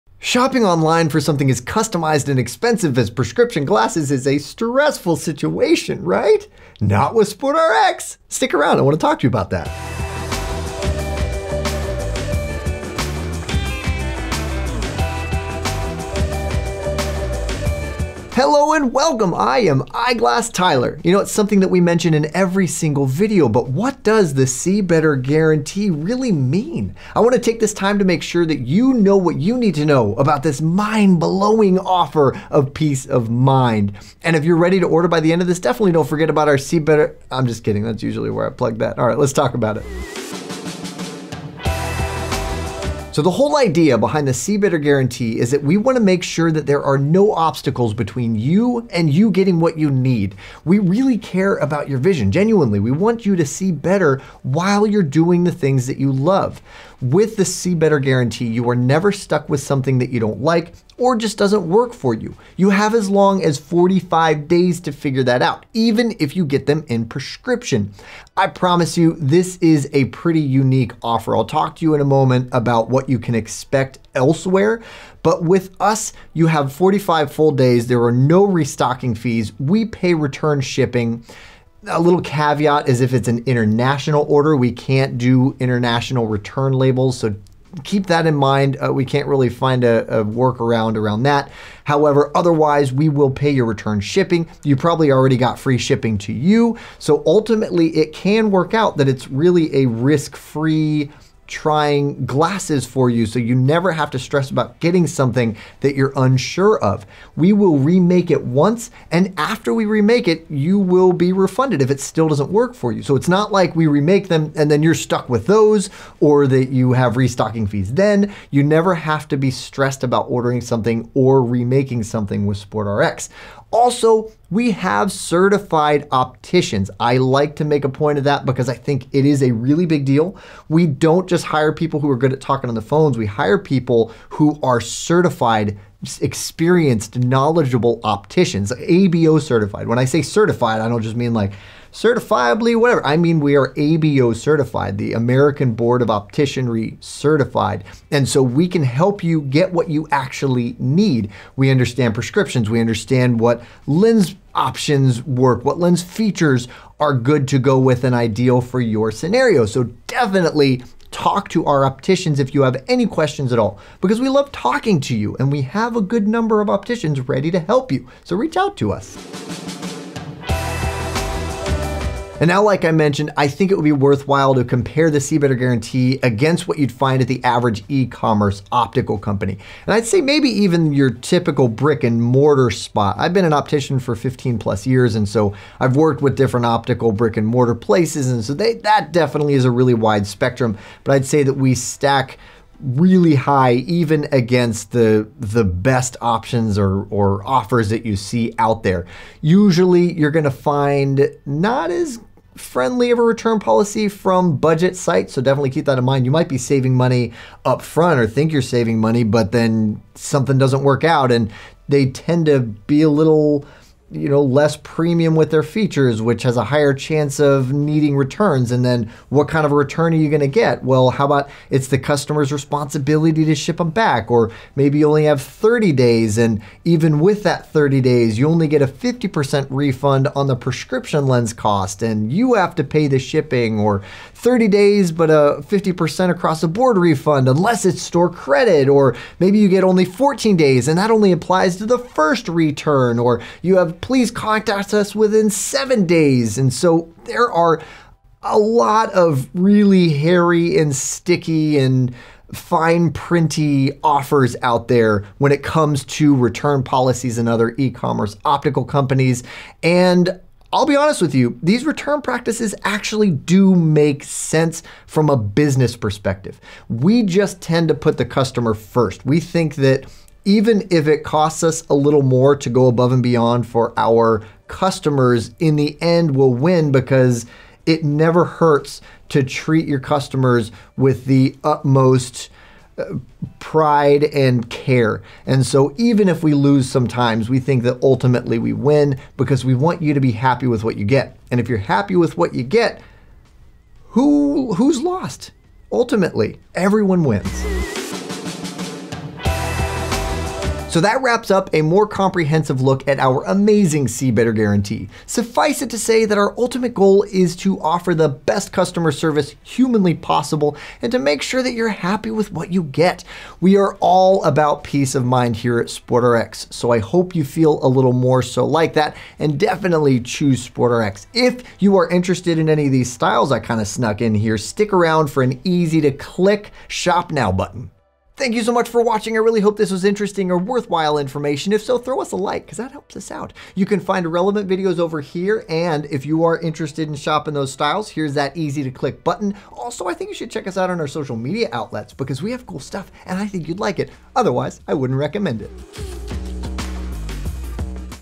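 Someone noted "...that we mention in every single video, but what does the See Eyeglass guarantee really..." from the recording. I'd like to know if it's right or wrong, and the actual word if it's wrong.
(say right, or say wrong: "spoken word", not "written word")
wrong: "Better", not "Eyeglass".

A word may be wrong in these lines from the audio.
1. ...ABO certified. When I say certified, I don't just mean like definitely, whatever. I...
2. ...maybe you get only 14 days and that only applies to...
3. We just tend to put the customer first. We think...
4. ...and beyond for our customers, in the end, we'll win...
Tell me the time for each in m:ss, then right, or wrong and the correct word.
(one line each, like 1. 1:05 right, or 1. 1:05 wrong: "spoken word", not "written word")
1. 2:18 wrong: "certifiably", not "definitely"
2. 3:59 right
3. 4:26 right
4. 4:33 right.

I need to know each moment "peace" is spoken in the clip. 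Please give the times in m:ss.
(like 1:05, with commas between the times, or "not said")
0:32, 5:14.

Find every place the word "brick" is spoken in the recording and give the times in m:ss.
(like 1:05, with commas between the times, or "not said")
3:01, 3:07.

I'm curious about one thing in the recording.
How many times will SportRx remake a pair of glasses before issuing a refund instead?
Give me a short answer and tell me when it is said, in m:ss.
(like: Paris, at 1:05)
Once, at 1:48.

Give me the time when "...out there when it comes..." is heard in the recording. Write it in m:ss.
4:14.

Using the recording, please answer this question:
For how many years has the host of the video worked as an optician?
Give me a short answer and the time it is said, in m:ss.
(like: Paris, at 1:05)
15 plus, at 3:04.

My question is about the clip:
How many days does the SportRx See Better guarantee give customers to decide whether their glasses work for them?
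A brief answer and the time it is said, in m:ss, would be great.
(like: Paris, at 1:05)
45, at 1:03.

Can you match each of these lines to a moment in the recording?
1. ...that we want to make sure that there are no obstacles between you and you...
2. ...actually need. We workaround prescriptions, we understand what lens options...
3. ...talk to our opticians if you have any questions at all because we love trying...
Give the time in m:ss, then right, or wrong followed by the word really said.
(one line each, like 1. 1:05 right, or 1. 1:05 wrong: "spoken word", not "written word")
1. 0:45 right
2. 2:30 wrong: "understand", not "workaround"
3. 2:41 wrong: "talking", not "trying".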